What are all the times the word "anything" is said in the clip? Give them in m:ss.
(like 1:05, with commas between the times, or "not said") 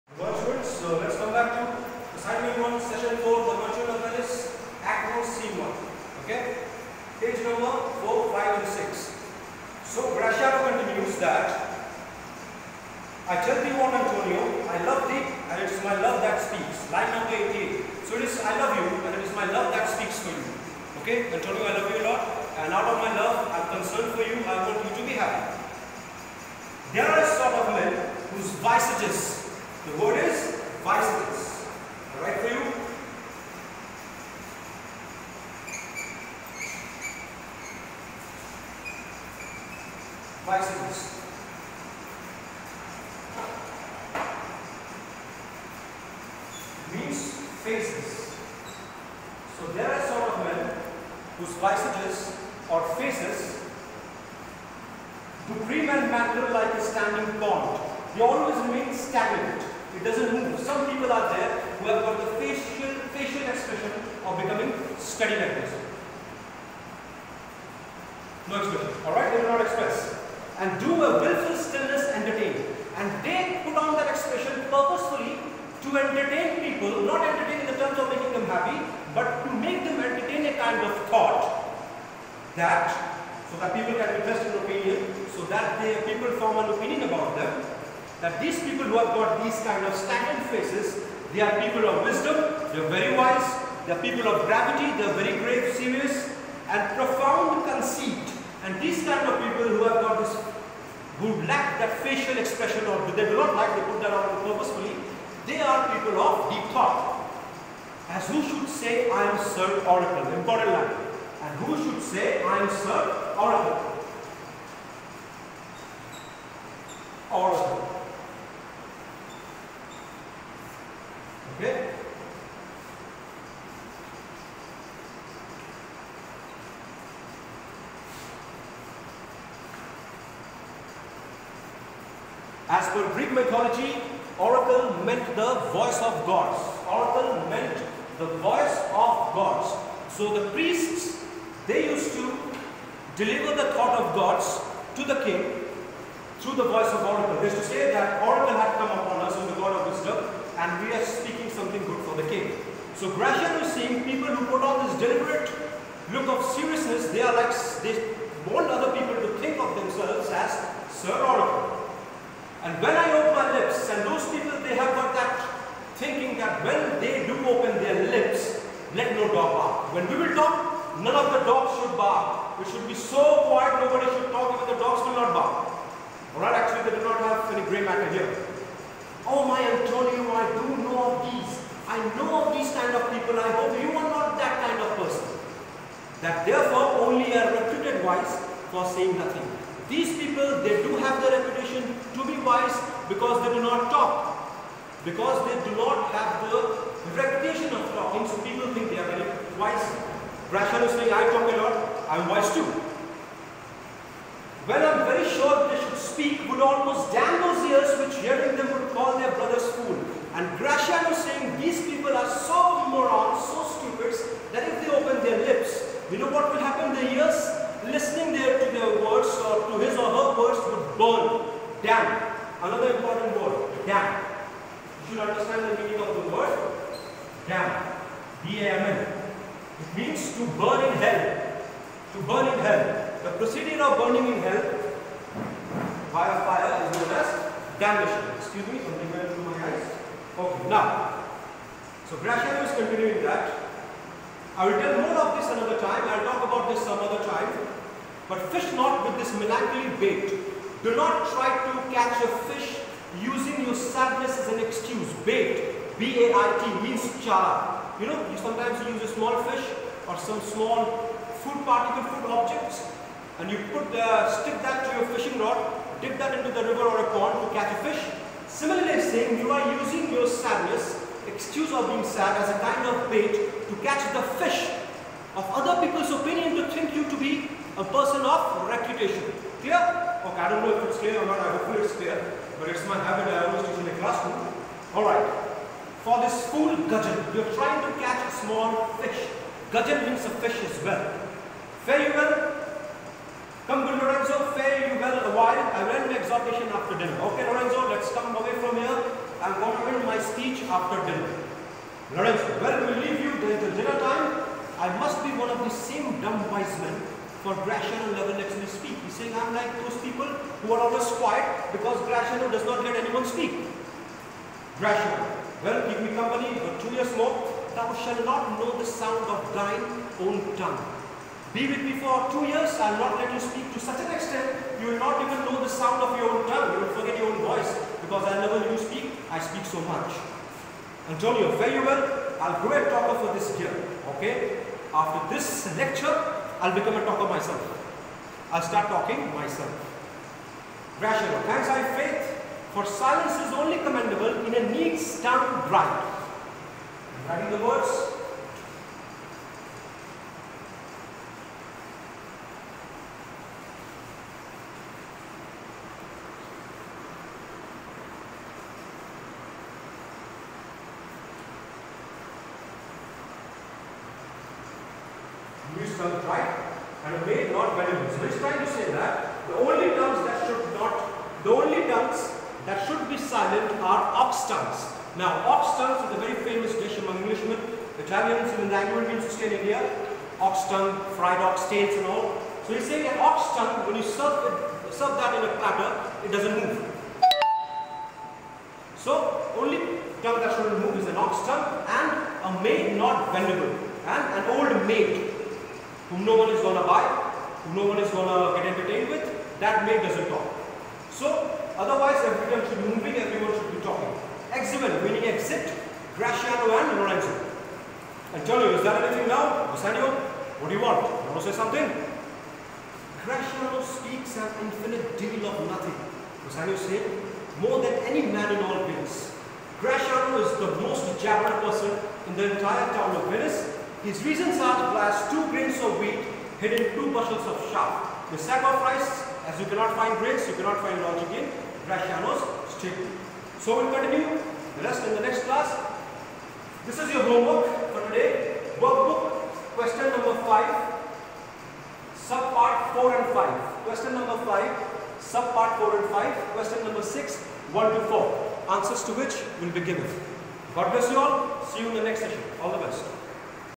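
6:49.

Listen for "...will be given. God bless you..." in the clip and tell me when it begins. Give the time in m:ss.
7:29.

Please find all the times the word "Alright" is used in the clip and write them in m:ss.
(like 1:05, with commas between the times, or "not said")
0:32, 1:09, 2:56.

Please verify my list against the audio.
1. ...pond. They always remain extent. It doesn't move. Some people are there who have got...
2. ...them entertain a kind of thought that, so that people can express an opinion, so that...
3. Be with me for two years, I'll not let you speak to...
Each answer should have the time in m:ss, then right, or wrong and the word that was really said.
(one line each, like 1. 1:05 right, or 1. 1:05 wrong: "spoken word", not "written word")
1. 0:57 wrong: "stagnant", not "extent"
2. 1:19 right
3. 5:21 right.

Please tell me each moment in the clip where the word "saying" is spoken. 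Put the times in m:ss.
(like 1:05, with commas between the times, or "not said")
3:08, 3:20, 3:31, 4:29, 5:09, 6:22.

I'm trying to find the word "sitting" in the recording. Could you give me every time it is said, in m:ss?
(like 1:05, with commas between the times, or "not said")
not said.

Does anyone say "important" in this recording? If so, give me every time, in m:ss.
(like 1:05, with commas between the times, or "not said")
1:50.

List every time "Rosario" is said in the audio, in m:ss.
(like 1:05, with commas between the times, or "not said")
6:49, 6:56.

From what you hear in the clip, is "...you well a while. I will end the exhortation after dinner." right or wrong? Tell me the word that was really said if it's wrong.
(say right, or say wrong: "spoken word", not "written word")
right.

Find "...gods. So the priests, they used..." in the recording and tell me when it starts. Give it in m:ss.
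2:19.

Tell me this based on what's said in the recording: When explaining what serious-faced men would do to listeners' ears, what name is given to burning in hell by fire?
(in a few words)
Damnation.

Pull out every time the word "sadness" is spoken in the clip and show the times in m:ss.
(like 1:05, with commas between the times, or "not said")
4:13, 4:30.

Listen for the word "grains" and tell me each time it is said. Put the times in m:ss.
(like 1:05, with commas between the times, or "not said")
7:05, 7:10.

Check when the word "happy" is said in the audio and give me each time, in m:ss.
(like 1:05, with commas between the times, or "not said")
0:25, 1:18.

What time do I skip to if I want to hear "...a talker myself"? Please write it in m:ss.
5:36.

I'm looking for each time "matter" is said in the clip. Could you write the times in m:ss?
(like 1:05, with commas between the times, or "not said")
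0:56, 2:57.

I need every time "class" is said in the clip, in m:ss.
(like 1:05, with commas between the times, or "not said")
4:44, 7:15.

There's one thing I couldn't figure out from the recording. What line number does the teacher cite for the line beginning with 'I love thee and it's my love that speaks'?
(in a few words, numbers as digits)
88.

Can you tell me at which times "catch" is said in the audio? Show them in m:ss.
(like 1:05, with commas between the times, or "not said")
4:11, 4:27, 4:33, 4:48.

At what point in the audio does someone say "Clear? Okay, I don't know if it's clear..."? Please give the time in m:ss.
4:39.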